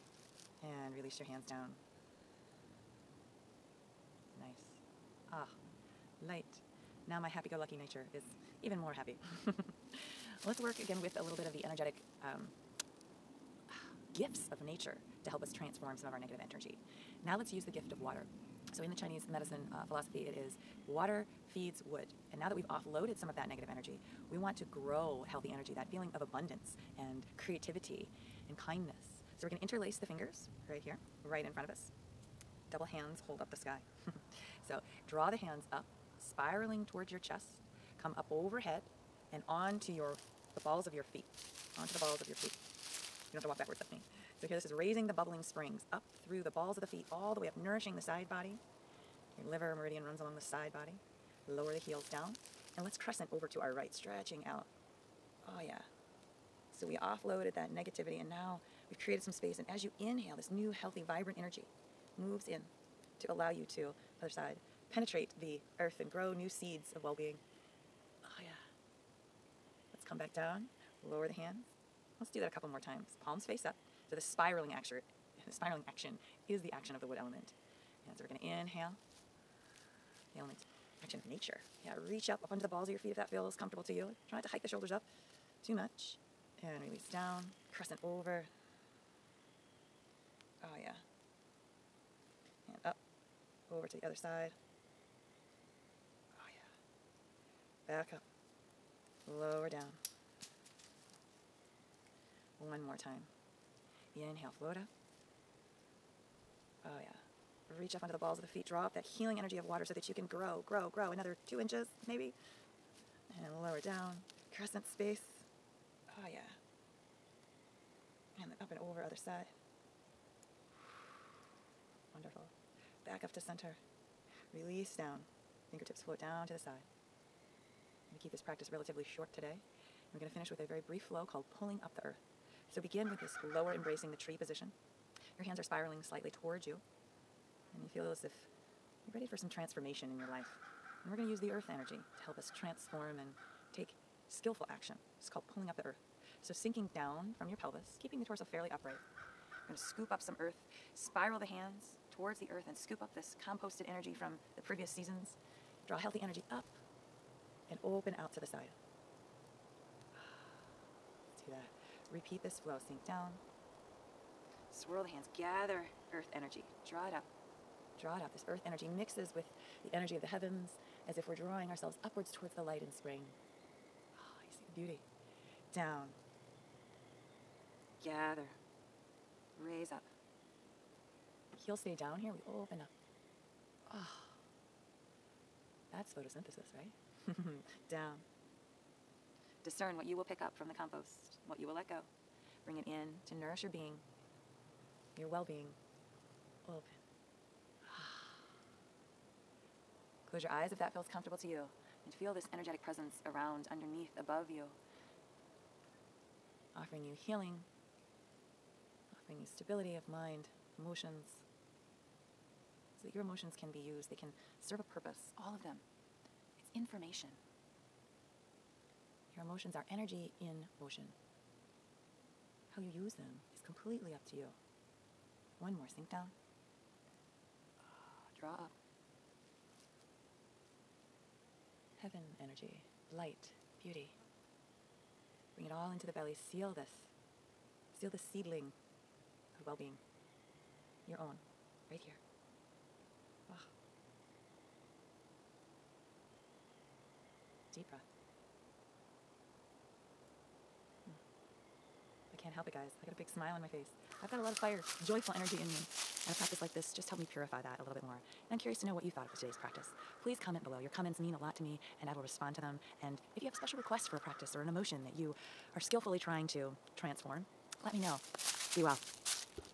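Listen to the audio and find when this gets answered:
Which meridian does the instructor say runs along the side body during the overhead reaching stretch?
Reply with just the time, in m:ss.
0:49.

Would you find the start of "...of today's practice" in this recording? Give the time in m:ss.
4:19.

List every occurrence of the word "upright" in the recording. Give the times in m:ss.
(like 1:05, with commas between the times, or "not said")
2:28.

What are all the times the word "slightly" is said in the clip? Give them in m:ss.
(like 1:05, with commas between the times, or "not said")
2:16.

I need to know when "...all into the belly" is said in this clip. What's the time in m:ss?
3:55.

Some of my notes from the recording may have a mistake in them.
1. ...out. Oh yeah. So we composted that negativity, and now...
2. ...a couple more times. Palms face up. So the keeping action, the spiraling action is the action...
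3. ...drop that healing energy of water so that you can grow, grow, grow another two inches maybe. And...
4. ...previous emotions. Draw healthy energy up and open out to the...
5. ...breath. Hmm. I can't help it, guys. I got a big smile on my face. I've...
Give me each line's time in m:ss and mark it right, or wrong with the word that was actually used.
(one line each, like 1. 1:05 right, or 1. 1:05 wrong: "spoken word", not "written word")
1. 0:54 wrong: "offloaded", not "composted"
2. 1:12 wrong: "spiraling", not "keeping"
3. 1:48 right
4. 2:34 wrong: "seasons", not "emotions"
5. 4:07 right.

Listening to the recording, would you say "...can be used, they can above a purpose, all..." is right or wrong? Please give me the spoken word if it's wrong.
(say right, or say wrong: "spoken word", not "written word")
wrong: "serve", not "above".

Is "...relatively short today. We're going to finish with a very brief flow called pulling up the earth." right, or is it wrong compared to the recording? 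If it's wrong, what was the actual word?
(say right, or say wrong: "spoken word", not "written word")
right.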